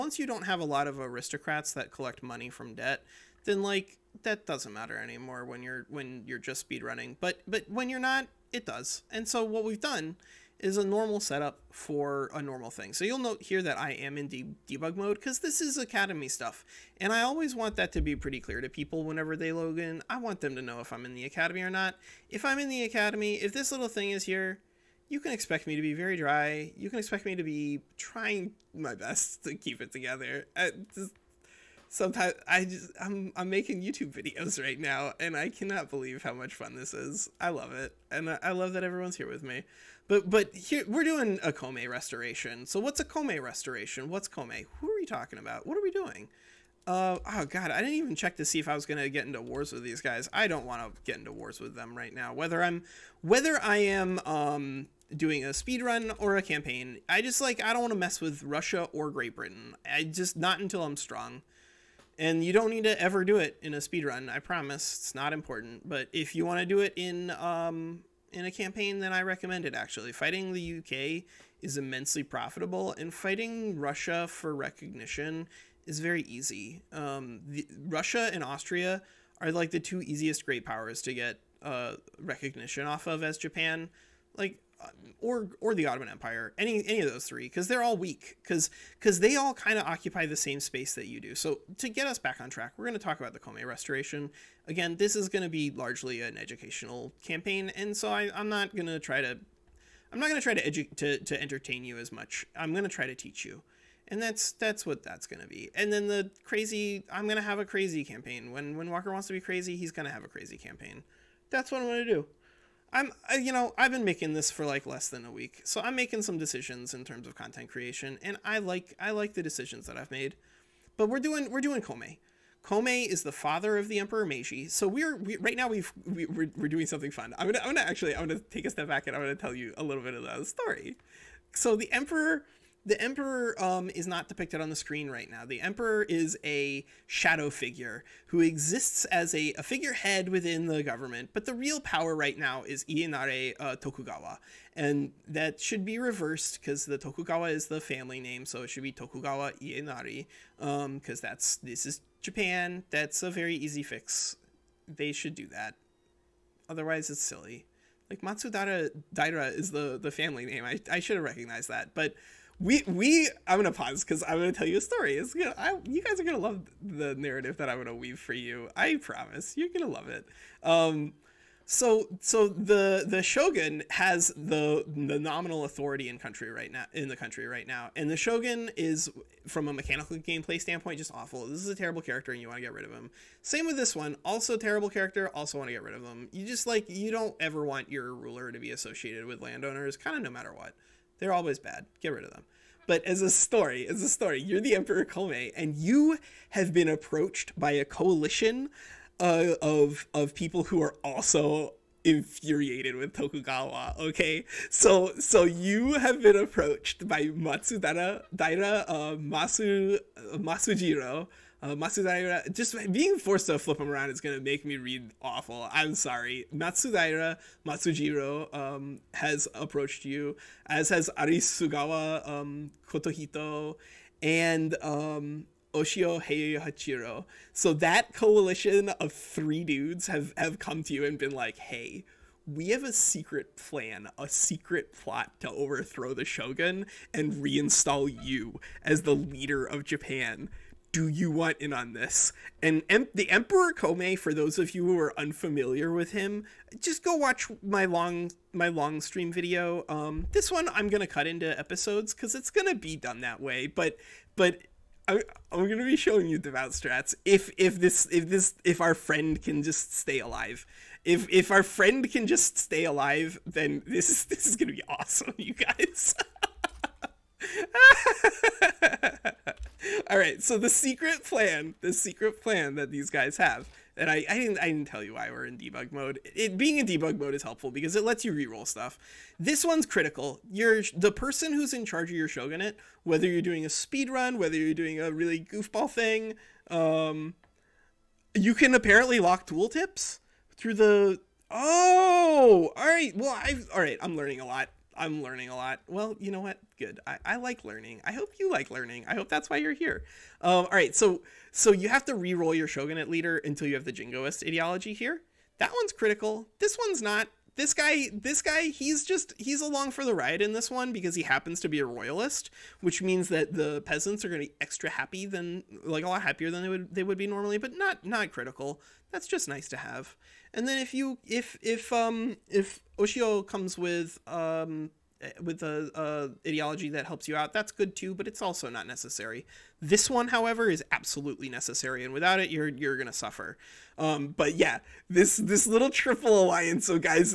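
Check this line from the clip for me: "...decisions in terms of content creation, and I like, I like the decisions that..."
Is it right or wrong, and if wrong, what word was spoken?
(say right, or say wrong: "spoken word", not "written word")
right.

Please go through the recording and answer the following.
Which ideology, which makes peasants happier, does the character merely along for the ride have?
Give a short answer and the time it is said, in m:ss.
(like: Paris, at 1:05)
royalist, at 5:11.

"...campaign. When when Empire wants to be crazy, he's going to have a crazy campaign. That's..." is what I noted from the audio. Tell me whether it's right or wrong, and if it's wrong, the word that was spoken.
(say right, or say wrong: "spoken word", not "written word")
wrong: "Walker", not "Empire".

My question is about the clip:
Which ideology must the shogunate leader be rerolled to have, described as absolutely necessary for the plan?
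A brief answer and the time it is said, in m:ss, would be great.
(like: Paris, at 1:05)
jingoist, at 5:03.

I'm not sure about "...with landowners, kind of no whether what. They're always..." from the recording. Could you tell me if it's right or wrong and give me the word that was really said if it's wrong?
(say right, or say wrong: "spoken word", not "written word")
wrong: "matter", not "whether".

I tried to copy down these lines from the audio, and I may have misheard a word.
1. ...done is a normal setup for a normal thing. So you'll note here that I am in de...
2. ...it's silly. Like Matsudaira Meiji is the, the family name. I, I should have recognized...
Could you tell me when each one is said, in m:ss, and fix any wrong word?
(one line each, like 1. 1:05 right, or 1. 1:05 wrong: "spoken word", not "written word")
1. 0:09 right
2. 2:37 wrong: "Daira", not "Meiji".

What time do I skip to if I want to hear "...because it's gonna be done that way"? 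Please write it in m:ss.
4:12.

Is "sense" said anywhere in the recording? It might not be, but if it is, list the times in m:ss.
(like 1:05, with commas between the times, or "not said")
not said.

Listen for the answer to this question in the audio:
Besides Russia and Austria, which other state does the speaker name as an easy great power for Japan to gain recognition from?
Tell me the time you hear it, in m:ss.
1:25.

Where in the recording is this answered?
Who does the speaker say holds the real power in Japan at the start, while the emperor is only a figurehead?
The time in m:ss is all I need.
2:22.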